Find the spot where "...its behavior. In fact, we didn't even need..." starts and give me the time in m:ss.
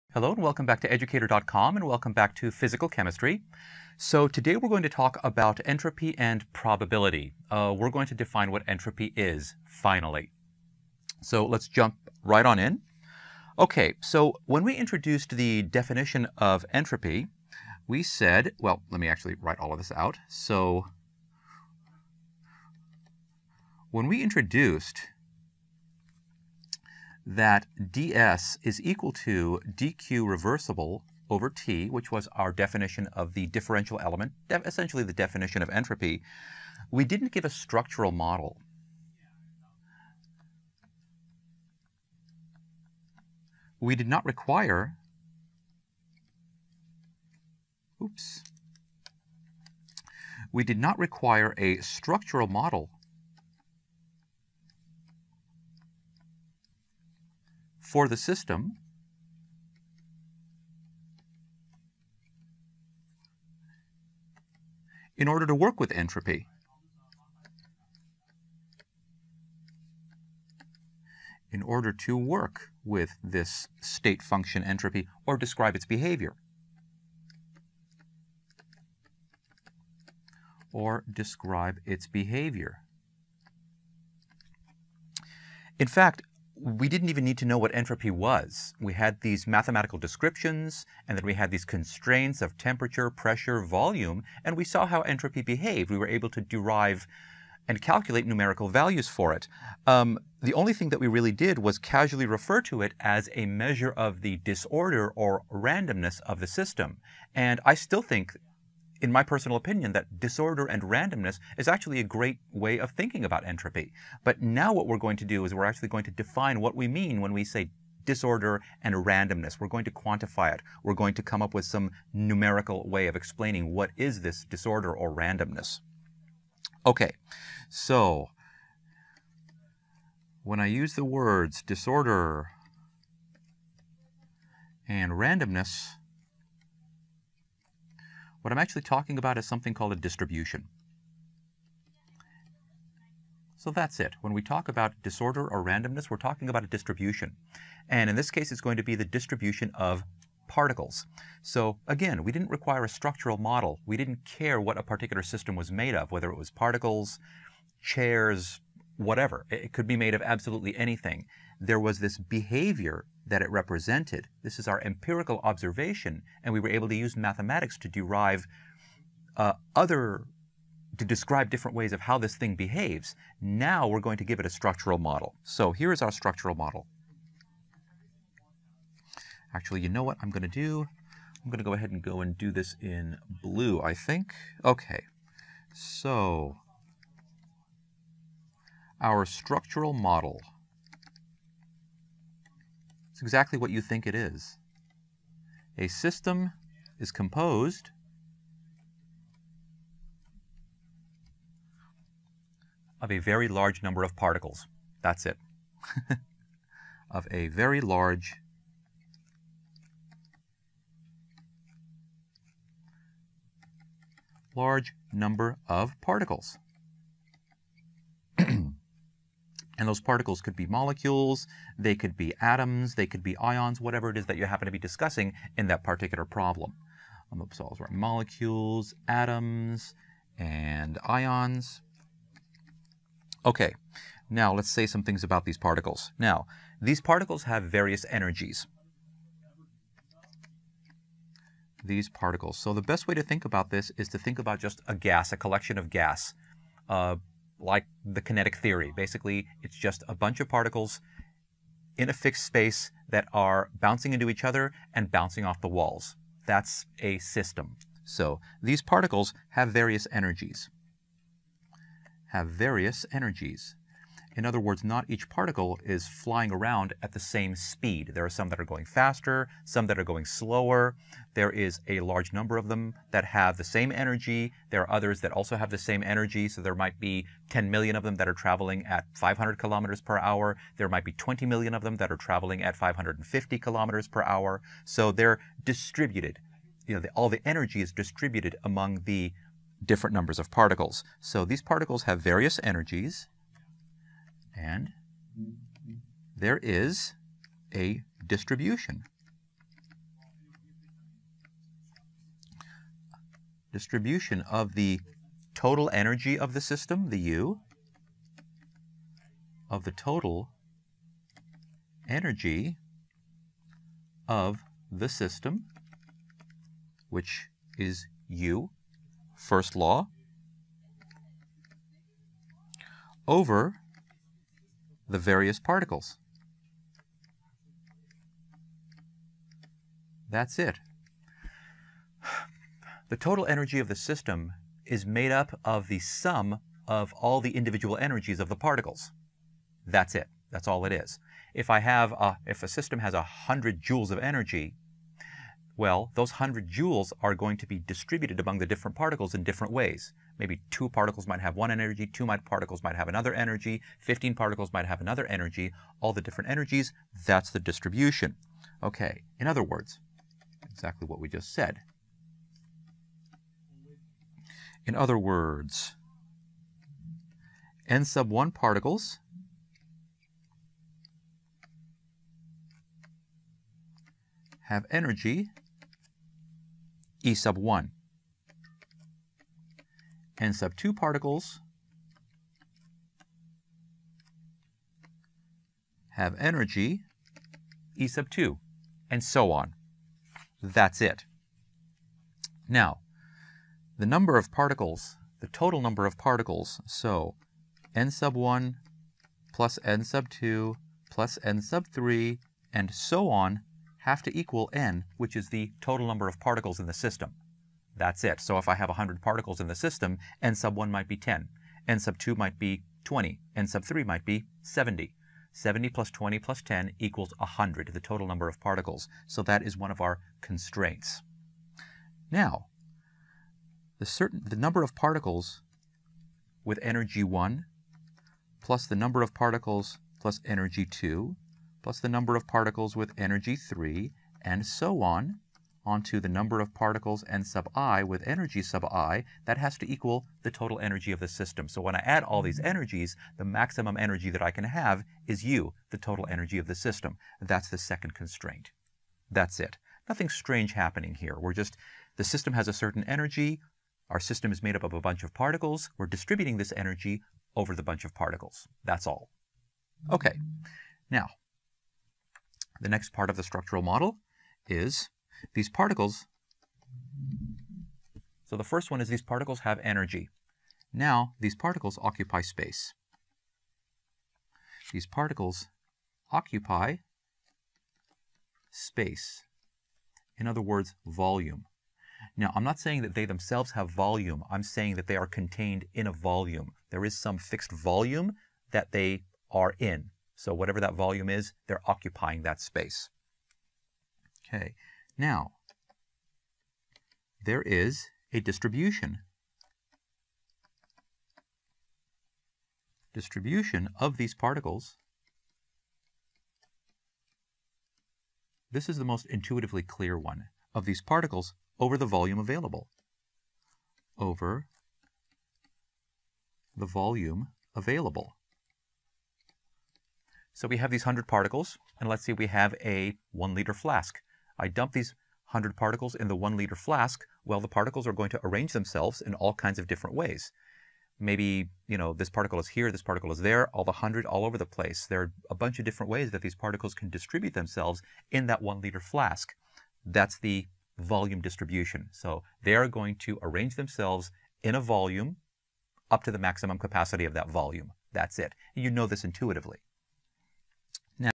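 1:21.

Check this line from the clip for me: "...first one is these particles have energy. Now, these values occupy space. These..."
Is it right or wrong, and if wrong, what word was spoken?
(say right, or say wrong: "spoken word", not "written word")
wrong: "particles", not "values".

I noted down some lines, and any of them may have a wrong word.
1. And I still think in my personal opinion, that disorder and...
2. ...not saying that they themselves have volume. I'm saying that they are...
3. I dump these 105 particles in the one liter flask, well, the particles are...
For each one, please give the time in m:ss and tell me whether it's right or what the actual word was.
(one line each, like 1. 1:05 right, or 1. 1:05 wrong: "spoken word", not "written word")
1. 1:47 right
2. 8:02 right
3. 8:44 wrong: "100", not "105".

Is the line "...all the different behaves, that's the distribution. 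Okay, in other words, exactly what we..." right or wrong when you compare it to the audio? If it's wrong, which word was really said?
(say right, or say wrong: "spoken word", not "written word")
wrong: "energies", not "behaves".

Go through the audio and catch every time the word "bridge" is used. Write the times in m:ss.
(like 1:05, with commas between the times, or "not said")
not said.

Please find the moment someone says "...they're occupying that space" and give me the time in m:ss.
8:11.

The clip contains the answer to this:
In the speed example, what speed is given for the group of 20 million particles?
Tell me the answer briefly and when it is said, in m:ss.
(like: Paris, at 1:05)
550 kilometers per hour, at 4:42.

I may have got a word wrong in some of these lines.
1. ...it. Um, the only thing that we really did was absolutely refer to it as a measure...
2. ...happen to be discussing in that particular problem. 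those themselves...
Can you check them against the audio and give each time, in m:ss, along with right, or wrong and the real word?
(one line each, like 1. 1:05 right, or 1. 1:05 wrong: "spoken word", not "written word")
1. 1:39 wrong: "casually", not "absolutely"
2. 3:44 wrong: "molecules", not "themselves".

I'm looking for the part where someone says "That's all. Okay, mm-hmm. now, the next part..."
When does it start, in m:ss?
7:38.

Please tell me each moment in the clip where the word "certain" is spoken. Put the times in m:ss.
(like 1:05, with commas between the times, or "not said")
7:04, 7:32.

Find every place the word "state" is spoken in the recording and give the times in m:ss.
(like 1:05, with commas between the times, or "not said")
1:13.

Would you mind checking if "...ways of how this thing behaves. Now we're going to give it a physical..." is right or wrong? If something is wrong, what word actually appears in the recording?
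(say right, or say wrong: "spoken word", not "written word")
wrong: "structural", not "physical".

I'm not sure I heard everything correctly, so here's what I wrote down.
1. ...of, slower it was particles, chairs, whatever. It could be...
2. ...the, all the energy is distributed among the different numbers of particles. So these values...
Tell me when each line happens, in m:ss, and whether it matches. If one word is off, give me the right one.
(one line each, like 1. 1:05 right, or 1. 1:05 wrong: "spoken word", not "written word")
1. 2:35 wrong: "whether", not "slower"
2. 4:47 wrong: "particles", not "values".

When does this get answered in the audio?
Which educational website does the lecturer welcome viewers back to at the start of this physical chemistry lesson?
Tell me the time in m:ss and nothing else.
0:00.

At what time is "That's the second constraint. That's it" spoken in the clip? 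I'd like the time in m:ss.
7:27.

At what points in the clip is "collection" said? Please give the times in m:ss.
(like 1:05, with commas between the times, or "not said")
4:05.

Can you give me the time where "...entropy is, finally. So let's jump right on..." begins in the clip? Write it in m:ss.
0:08.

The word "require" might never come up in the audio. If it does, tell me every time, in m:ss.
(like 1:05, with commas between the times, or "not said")
0:44, 0:50, 2:32.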